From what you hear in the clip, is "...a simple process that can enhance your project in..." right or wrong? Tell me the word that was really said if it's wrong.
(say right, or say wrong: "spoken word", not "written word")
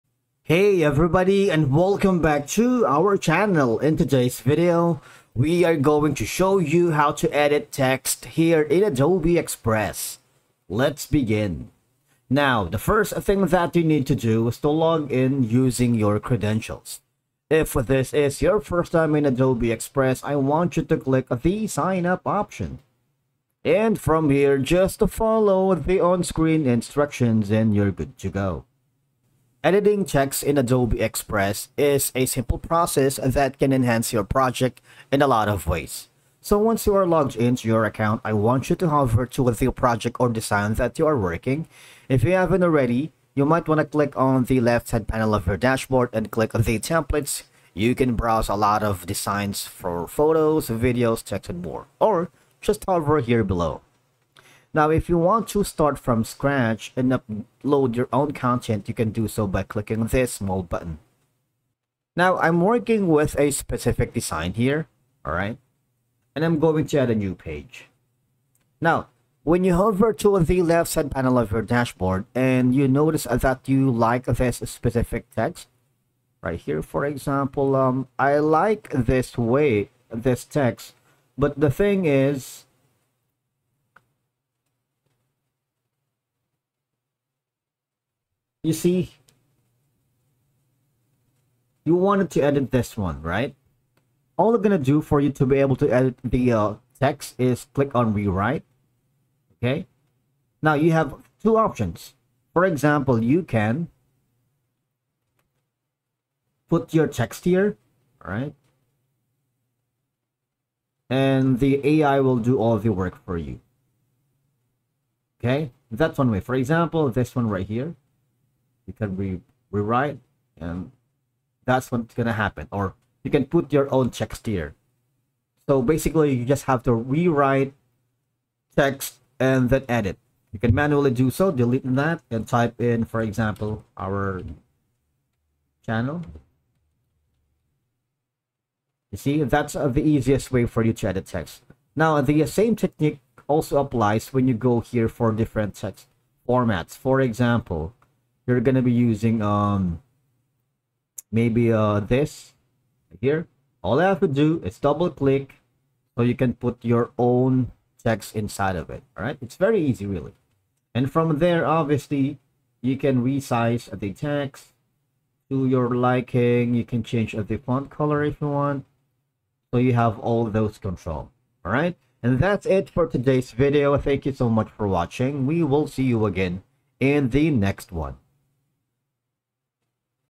right.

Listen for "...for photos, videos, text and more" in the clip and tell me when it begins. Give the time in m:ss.
0:49.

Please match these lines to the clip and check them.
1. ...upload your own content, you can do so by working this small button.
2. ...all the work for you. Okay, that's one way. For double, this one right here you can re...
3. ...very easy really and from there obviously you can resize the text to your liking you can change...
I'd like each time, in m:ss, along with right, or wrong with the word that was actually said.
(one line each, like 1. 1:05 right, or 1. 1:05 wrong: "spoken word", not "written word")
1. 0:57 wrong: "clicking", not "working"
2. 1:52 wrong: "example", not "double"
3. 2:39 right.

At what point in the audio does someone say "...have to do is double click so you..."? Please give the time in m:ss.
2:34.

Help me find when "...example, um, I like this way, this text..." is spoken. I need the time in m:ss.
1:17.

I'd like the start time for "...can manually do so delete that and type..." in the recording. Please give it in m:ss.
2:10.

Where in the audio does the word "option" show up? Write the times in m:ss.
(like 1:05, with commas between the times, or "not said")
0:22, 1:41.